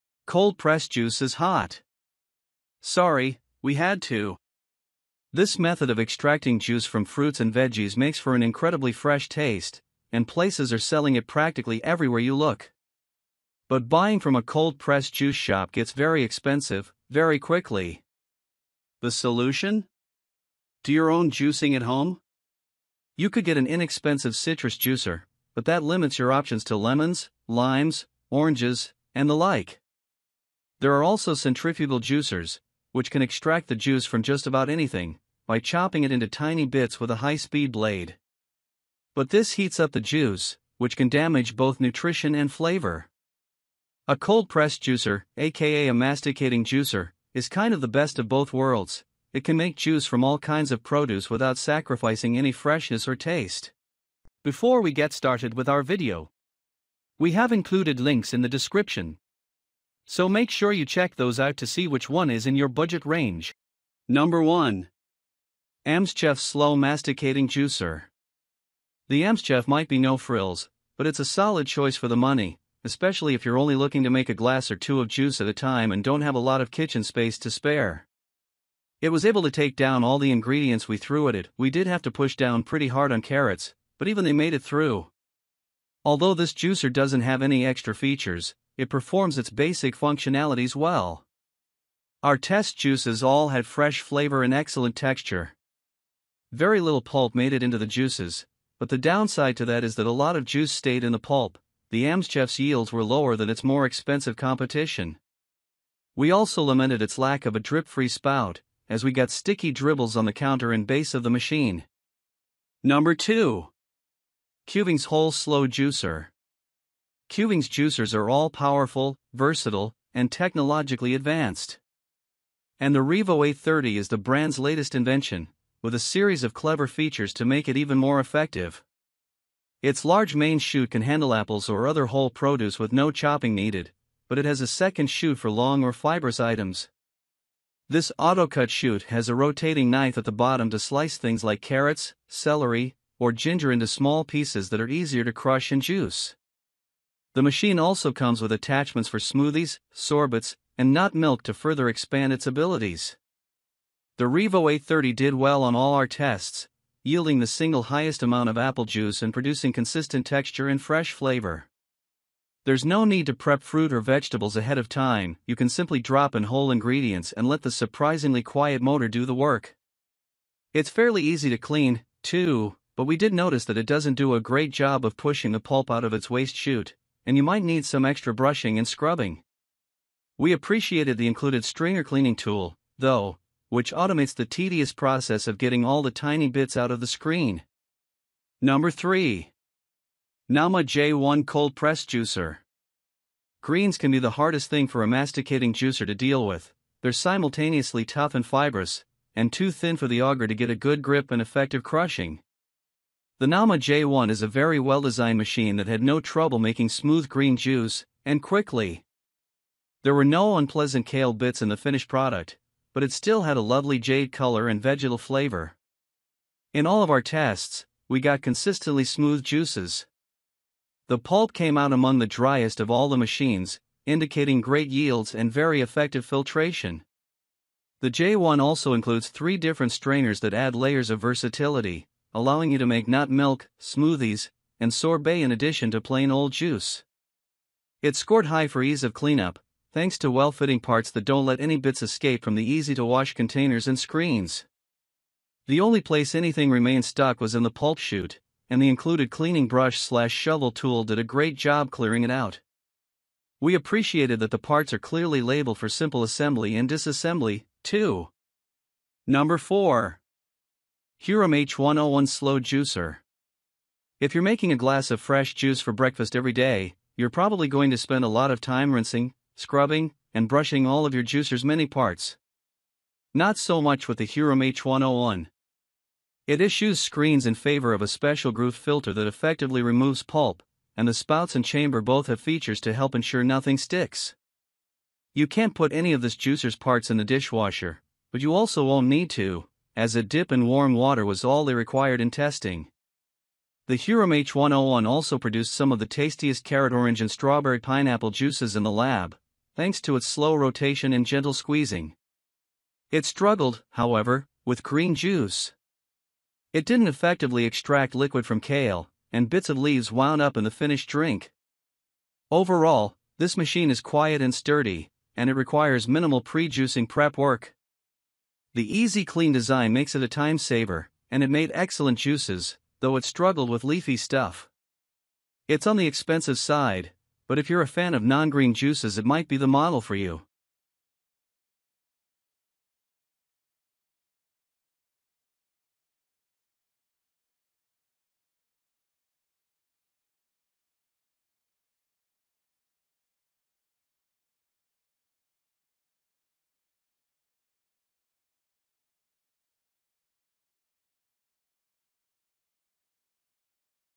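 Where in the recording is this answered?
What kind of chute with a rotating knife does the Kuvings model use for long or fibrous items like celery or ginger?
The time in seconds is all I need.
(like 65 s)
138 s.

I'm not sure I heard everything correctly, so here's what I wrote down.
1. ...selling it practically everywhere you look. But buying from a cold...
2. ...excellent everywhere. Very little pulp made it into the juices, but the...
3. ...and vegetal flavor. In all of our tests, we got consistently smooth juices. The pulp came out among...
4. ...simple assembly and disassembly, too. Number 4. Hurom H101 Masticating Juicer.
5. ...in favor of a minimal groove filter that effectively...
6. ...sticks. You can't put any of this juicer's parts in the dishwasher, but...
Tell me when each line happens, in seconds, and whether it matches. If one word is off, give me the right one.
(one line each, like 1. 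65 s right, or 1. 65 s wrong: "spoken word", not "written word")
1. 10 s right
2. 94 s wrong: "texture", not "everywhere"
3. 214 s right
4. 255 s wrong: "Slow", not "Masticating"
5. 277 s wrong: "special", not "minimal"
6. 283 s right.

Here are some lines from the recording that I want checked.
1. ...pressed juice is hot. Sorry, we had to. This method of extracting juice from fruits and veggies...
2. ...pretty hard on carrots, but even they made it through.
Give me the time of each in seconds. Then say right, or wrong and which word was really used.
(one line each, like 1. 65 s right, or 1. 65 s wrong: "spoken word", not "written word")
1. 0 s right
2. 82 s right.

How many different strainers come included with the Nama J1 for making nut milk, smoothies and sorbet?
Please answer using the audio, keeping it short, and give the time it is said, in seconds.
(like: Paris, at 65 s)
3, at 229 s.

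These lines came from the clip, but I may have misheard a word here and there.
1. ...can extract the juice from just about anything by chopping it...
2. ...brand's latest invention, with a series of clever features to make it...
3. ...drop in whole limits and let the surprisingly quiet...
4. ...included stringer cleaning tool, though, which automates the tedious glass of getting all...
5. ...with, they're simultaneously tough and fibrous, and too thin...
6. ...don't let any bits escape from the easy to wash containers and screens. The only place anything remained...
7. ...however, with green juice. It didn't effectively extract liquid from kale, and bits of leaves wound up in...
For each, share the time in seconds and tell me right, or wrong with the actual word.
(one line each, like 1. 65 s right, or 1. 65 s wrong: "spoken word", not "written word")
1. 33 s right
2. 124 s right
3. 166 s wrong: "ingredients", not "limits"
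4. 181 s wrong: "process", not "glass"
5. 196 s right
6. 241 s right
7. 303 s right.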